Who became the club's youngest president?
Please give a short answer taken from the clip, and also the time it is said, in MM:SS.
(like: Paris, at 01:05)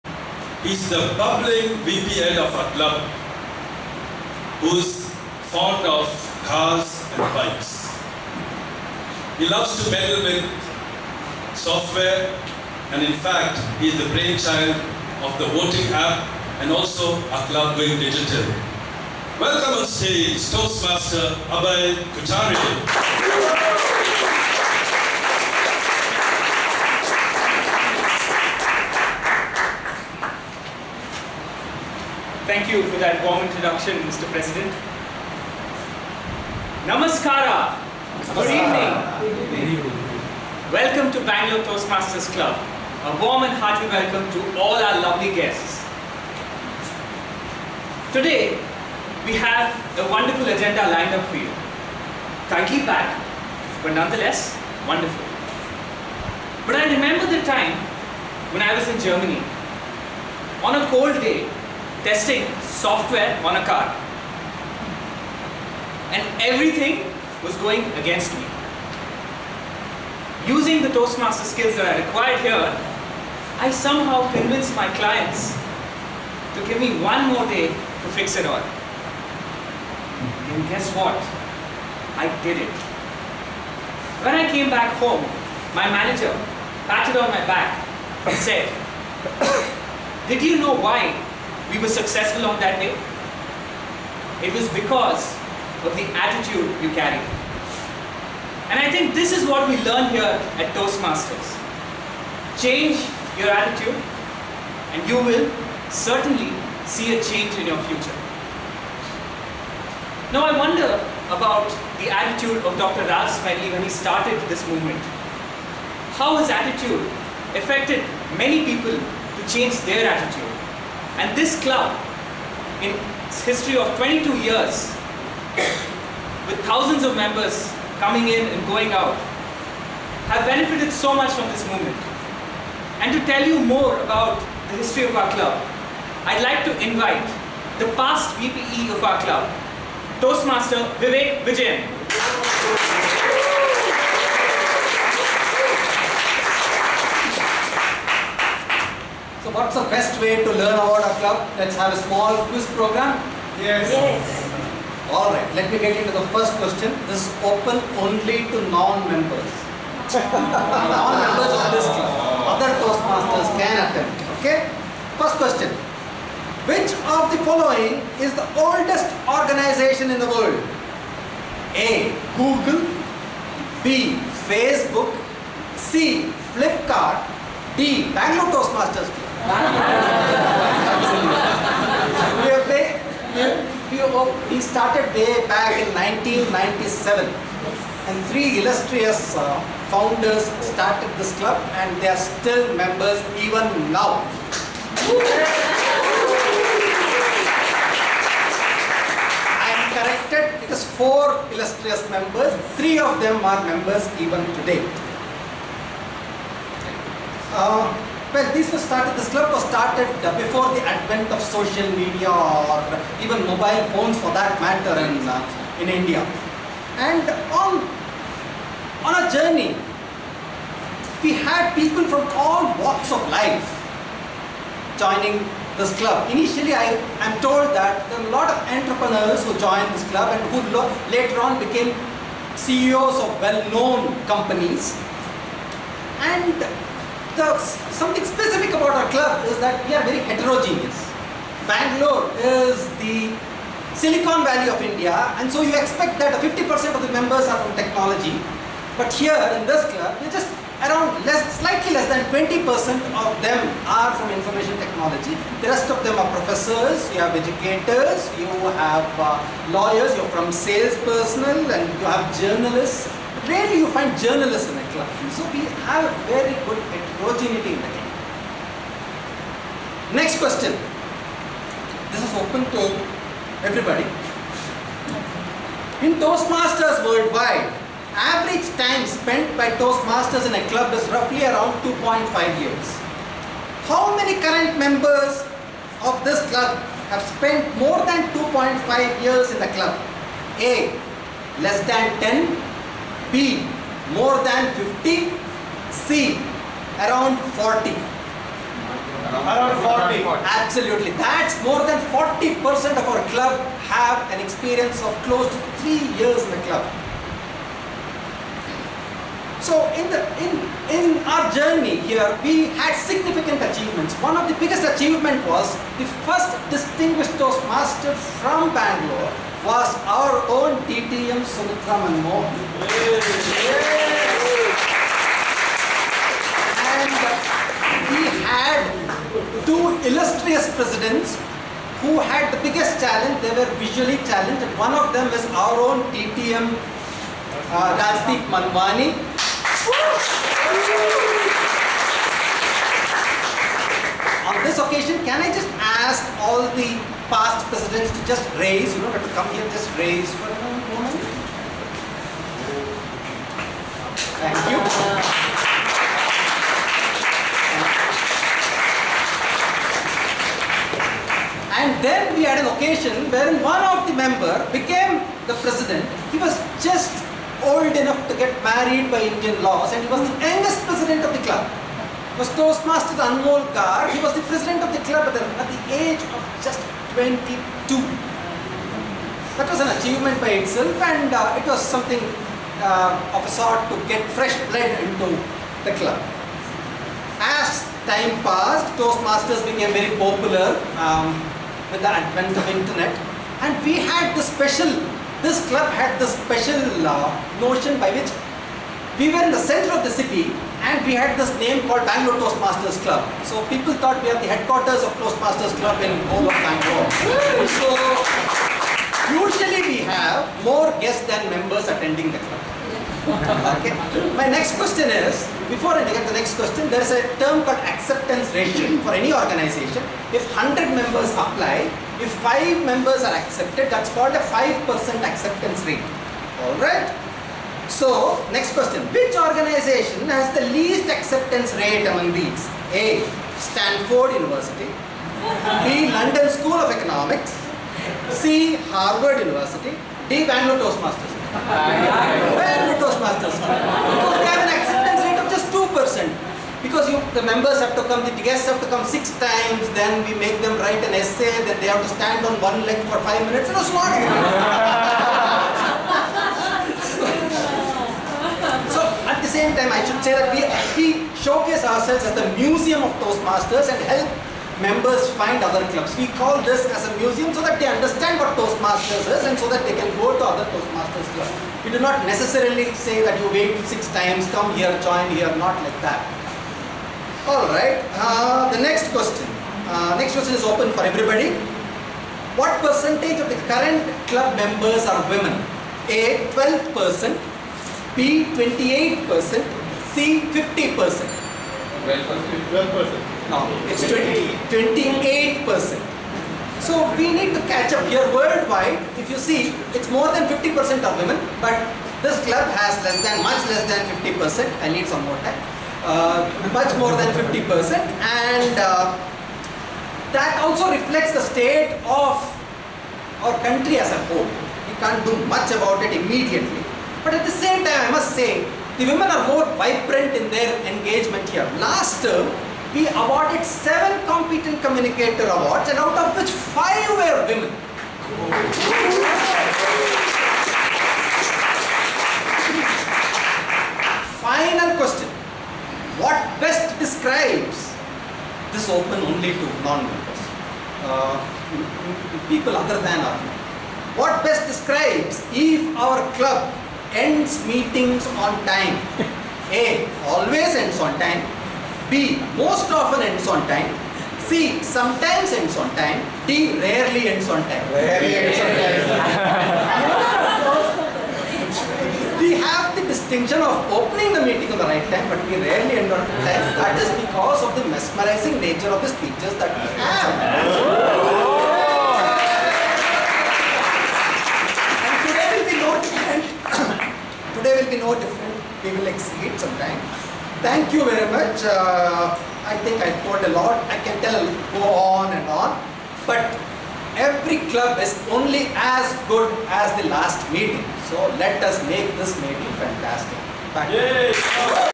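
Anmol Kar, at 06:13.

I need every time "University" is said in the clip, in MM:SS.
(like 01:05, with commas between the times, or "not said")
07:14, 07:19.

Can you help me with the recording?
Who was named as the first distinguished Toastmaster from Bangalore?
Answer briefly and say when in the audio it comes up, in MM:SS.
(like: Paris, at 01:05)
Sumitra Mohan, at 05:21.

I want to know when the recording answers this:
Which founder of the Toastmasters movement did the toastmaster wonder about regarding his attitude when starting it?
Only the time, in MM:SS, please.
01:53.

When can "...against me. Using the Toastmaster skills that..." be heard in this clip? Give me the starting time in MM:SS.
01:07.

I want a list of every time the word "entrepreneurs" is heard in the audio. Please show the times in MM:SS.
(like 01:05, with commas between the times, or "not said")
03:48.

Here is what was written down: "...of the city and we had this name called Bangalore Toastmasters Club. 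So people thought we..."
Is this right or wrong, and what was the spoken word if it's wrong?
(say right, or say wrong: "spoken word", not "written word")
right.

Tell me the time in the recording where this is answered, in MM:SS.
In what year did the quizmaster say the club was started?
03:05.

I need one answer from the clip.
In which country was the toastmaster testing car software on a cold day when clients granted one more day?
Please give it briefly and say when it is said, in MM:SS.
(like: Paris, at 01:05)
Germany, at 00:58.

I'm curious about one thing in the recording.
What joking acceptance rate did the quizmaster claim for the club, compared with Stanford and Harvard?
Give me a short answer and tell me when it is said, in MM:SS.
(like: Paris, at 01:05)
2%, at 07:25.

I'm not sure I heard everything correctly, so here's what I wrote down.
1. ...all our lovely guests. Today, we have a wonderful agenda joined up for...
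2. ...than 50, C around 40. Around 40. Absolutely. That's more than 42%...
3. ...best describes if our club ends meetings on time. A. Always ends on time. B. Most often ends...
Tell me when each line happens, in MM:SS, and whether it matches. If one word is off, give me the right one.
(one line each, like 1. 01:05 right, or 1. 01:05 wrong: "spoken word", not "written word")
1. 00:44 wrong: "lined", not "joined"
2. 04:54 wrong: "40", not "42"
3. 09:04 right.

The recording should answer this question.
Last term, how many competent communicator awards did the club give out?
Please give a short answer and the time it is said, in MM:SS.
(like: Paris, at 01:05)
7, at 08:43.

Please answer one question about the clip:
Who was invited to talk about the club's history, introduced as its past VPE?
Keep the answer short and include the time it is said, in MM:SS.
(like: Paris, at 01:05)
Vivek Vijayan, at 02:20.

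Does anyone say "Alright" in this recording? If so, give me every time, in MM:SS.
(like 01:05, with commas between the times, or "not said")
02:35, 07:06, 07:57.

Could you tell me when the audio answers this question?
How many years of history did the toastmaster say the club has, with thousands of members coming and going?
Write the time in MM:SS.
02:03.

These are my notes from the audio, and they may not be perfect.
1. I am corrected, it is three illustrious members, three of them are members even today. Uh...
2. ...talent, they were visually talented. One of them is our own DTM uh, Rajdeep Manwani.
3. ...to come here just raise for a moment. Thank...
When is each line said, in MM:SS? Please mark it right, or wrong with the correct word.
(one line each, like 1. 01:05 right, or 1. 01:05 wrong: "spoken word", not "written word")
1. 03:19 wrong: "four", not "three"
2. 05:32 right
3. 05:49 right.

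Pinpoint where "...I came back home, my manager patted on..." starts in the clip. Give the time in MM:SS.
01:24.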